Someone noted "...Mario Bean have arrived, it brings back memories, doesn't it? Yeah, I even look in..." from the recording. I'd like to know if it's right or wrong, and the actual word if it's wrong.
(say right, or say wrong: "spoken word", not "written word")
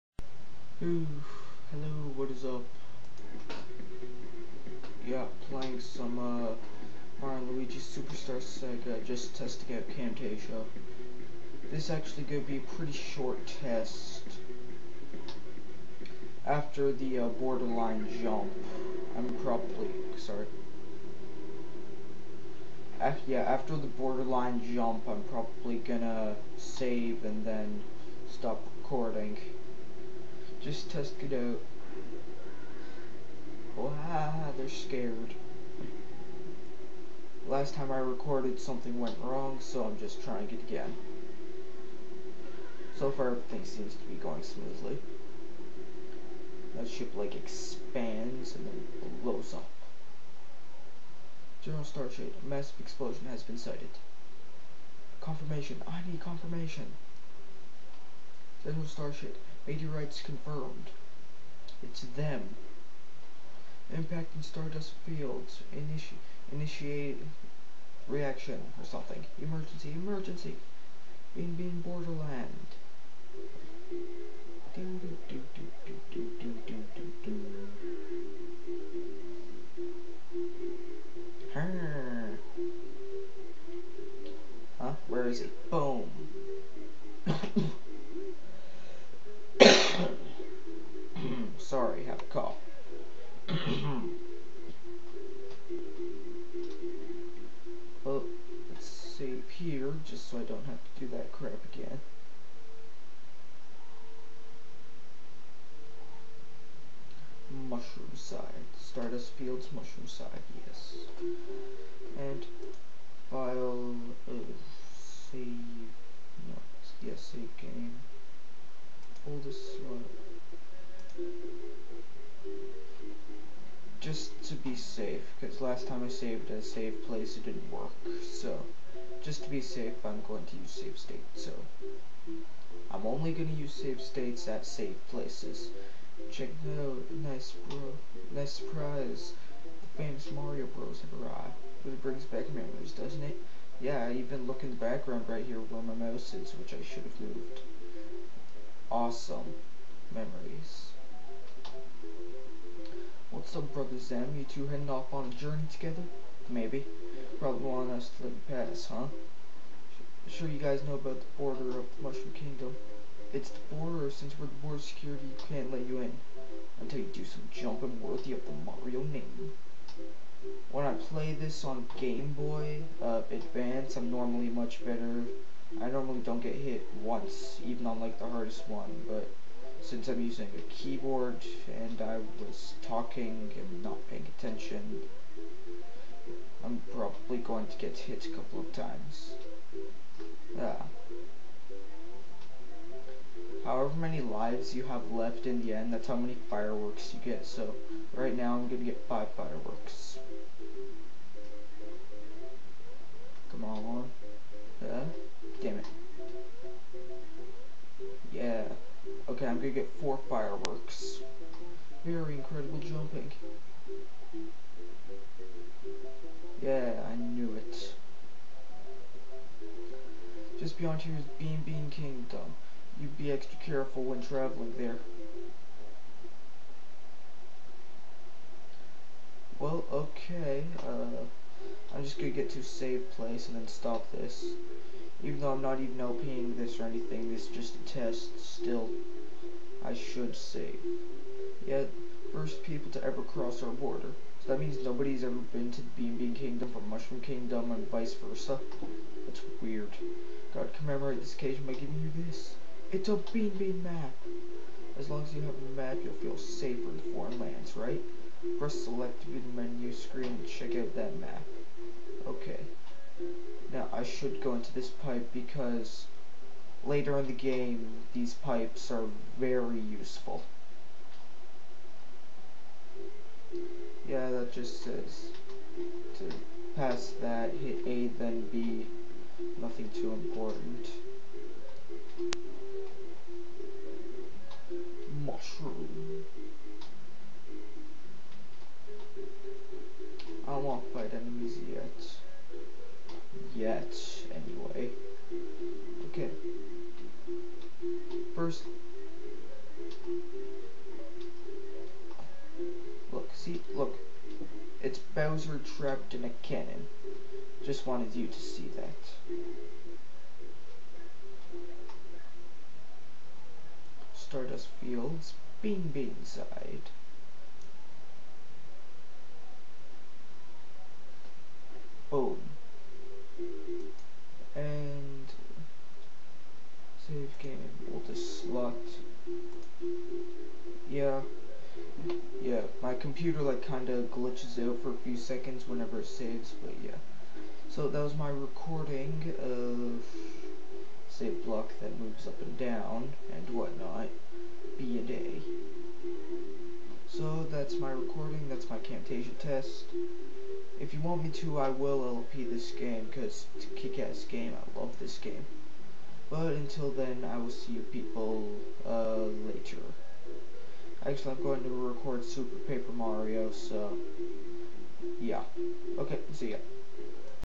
wrong: "Bros", not "Bean".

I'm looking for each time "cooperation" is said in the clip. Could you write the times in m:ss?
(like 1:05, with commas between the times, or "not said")
not said.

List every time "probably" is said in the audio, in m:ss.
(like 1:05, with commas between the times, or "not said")
0:19, 0:25, 2:37, 3:06.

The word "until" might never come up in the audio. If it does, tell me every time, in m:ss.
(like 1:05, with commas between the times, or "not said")
2:46, 5:56.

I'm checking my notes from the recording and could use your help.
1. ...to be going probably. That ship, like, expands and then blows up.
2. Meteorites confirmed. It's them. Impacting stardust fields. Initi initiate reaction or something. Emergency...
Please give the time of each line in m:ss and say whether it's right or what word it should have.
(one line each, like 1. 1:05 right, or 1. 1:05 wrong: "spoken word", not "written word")
1. 0:43 wrong: "smoothly", not "probably"
2. 0:59 right.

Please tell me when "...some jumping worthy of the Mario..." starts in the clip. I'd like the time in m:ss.
2:47.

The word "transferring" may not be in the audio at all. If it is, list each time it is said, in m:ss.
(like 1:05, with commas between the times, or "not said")
not said.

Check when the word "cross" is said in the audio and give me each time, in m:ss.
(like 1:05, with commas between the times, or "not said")
4:03.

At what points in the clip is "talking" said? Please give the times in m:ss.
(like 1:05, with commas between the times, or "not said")
3:02.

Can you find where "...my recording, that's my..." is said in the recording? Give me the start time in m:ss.
5:47.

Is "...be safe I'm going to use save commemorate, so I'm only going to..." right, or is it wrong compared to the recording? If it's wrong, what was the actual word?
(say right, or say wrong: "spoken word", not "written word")
wrong: "state", not "commemorate".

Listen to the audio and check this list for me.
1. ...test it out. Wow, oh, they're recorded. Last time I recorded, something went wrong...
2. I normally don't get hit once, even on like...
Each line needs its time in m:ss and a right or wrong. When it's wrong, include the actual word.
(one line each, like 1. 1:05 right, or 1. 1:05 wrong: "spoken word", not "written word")
1. 0:30 wrong: "scared", not "recorded"
2. 2:55 right.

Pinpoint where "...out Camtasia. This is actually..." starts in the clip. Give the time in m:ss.
0:09.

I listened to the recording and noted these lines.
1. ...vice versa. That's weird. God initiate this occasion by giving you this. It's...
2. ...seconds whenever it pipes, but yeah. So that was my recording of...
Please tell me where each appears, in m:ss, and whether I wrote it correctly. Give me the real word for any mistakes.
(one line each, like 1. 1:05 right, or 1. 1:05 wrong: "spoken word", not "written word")
1. 4:07 wrong: "commemorate", not "initiate"
2. 5:35 wrong: "saves", not "pipes".